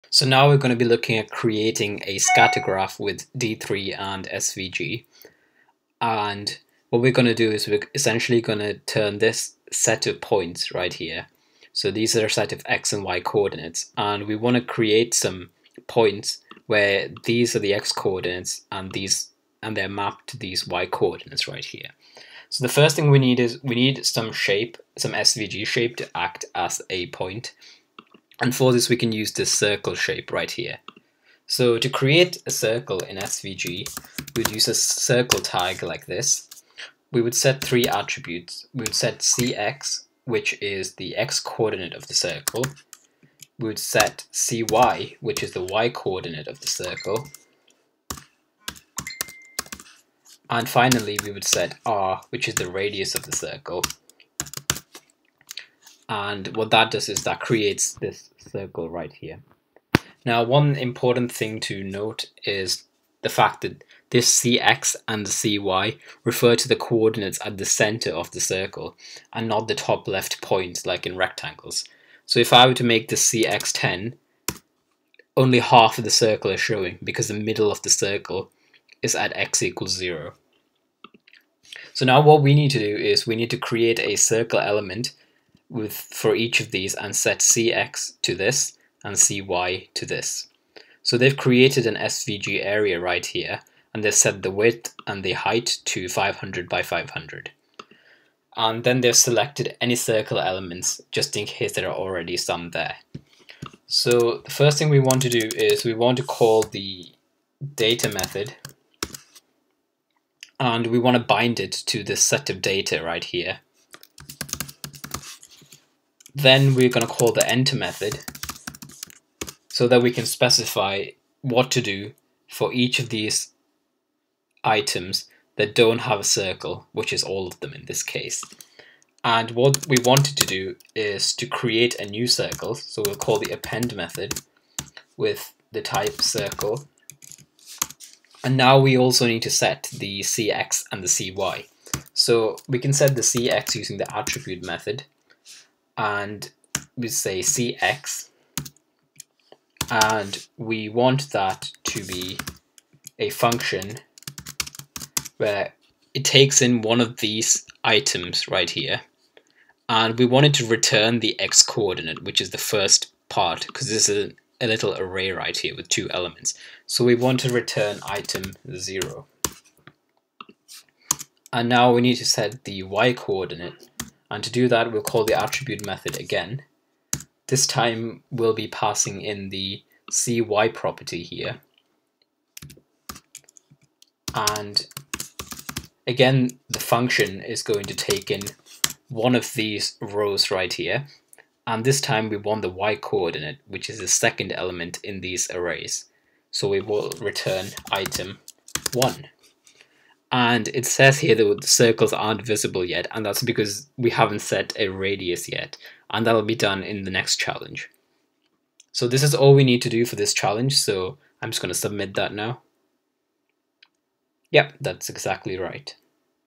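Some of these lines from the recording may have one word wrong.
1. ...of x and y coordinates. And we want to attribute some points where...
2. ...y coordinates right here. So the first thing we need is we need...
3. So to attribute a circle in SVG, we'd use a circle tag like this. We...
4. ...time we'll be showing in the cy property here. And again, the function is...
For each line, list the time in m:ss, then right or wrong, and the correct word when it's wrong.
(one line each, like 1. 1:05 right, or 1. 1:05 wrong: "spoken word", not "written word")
1. 0:12 wrong: "create", not "attribute"
2. 0:20 right
3. 0:31 wrong: "create", not "attribute"
4. 2:57 wrong: "passing", not "showing".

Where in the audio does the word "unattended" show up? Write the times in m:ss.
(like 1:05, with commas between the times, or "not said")
not said.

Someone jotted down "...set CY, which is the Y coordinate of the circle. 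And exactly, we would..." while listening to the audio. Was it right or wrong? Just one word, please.
wrong.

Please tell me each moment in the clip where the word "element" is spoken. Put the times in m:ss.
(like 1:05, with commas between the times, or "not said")
1:24, 1:40, 2:46, 3:14.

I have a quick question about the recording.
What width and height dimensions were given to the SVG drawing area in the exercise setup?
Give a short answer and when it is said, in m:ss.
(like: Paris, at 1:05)
500 by 500, at 1:36.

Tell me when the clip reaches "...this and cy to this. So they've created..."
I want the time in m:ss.
1:28.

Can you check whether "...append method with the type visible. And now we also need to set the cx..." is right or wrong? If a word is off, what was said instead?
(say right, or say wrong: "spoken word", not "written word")
wrong: "circle", not "visible".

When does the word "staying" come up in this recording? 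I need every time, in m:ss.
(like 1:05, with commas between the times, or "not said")
not said.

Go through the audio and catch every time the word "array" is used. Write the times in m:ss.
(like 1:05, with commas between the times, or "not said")
2:44, 3:15.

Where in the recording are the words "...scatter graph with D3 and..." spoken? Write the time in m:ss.
0:02.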